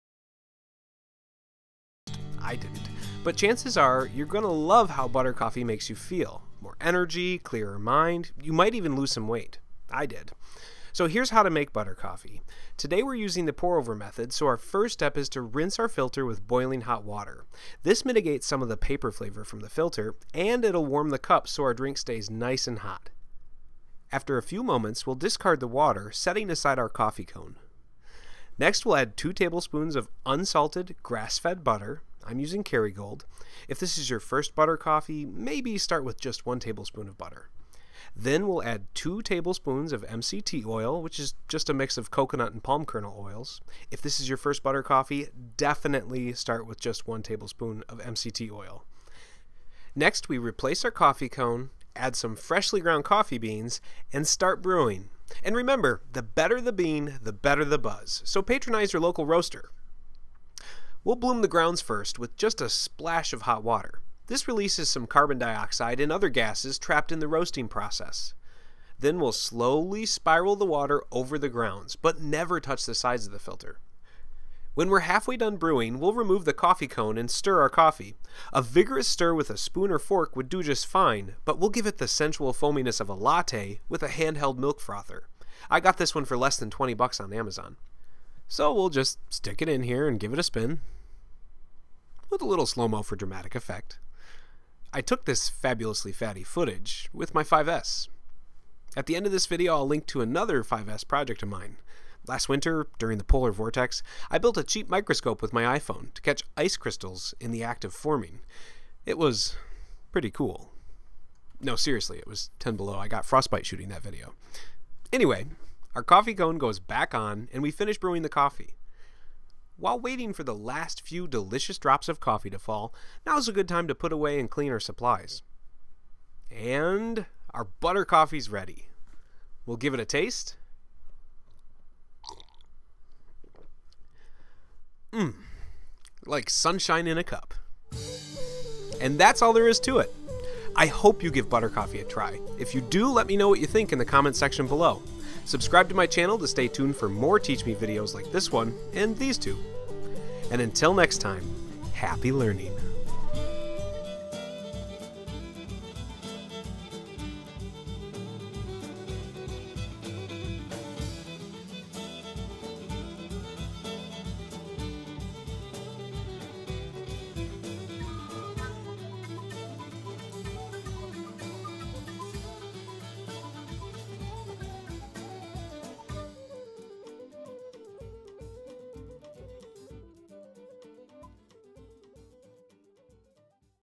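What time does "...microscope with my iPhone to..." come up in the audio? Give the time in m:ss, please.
1:44.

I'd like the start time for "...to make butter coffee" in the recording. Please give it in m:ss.
0:11.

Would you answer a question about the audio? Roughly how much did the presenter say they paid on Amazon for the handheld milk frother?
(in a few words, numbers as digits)
less than $20.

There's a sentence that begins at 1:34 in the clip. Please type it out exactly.
I took this fabulously fatty footage with my 5S.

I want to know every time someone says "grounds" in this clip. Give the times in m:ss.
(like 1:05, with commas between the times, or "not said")
0:52, 1:01, 1:11.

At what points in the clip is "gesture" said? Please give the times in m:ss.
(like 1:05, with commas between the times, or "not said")
not said.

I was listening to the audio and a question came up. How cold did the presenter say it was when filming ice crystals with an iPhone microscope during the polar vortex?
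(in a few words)
10 below.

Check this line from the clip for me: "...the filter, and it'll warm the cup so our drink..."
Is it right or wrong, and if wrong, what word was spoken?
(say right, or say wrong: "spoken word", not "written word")
right.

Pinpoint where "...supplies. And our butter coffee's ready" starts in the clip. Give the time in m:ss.
2:04.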